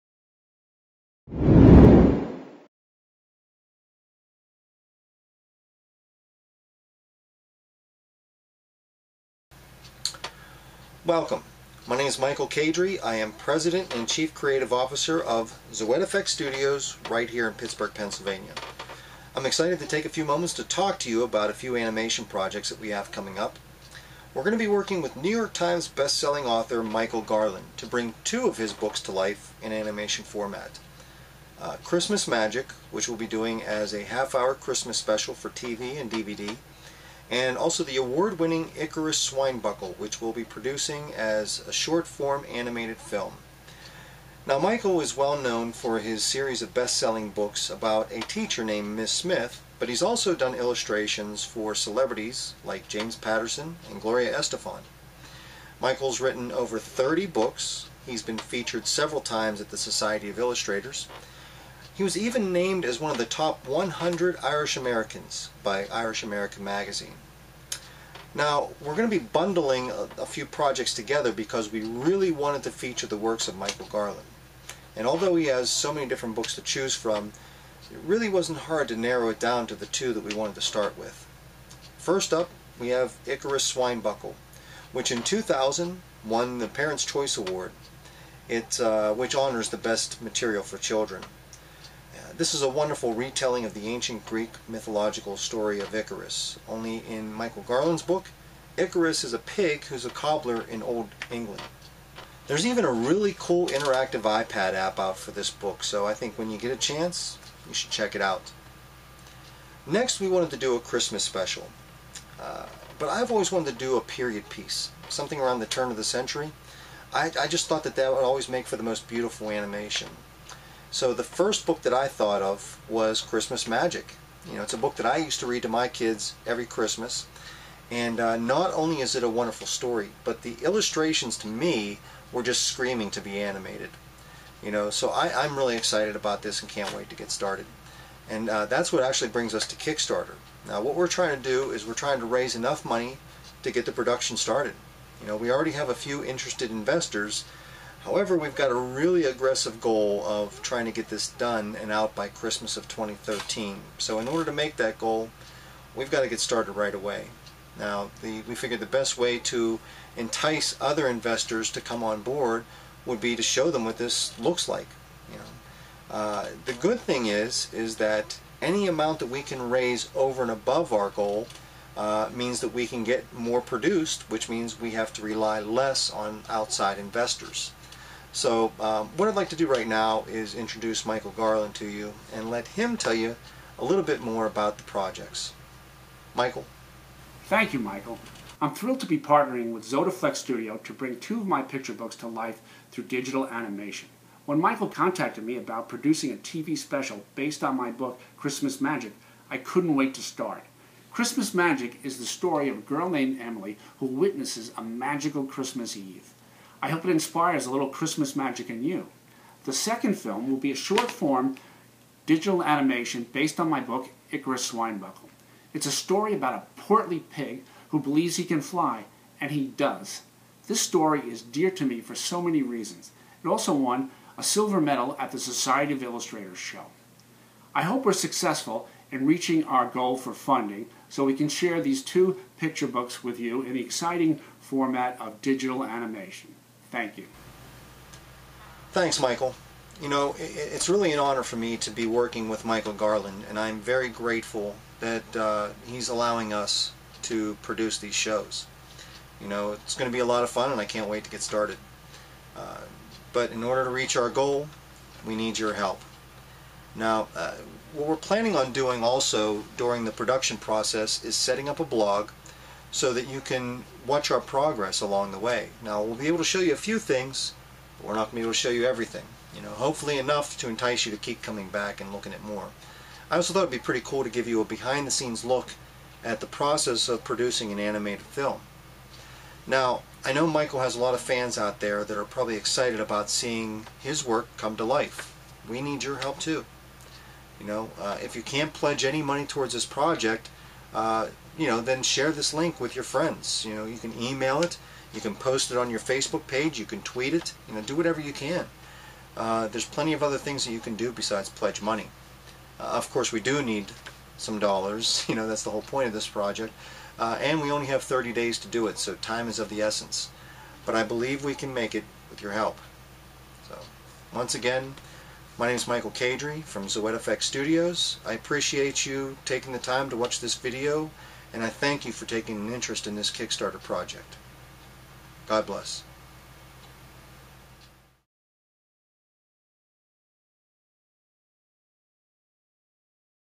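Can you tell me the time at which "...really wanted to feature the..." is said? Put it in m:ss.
1:11.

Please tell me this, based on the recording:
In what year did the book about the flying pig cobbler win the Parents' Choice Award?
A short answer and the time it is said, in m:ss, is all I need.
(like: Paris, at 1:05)
2000, at 1:25.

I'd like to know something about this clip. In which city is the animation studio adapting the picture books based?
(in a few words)
Pittsburgh, Pennsylvania.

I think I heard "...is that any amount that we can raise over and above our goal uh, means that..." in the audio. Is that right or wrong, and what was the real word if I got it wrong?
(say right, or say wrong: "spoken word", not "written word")
right.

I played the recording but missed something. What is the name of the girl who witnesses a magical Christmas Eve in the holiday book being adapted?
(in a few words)
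Emily.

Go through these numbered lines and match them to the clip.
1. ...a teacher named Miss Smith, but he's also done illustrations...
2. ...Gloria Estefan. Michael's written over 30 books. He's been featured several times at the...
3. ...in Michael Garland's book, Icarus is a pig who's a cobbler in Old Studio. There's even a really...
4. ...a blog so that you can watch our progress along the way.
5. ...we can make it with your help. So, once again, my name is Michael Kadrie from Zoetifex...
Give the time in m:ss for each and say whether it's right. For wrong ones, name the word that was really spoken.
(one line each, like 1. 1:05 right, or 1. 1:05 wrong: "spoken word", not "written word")
1. 0:48 right
2. 0:54 right
3. 1:37 wrong: "England", not "Studio"
4. 4:21 right
5. 5:11 right.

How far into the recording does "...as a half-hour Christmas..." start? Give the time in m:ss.
0:33.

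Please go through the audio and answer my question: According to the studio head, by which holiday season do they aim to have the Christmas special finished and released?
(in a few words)
Christmas of 2013.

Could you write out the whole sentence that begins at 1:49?
Next, we wanted to do a Christmas special.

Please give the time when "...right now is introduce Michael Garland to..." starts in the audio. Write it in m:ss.
2:59.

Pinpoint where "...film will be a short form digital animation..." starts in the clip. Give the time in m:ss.
3:30.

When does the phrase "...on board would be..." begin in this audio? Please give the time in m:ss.
2:42.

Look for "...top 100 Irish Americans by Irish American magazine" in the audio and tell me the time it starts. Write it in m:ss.
1:03.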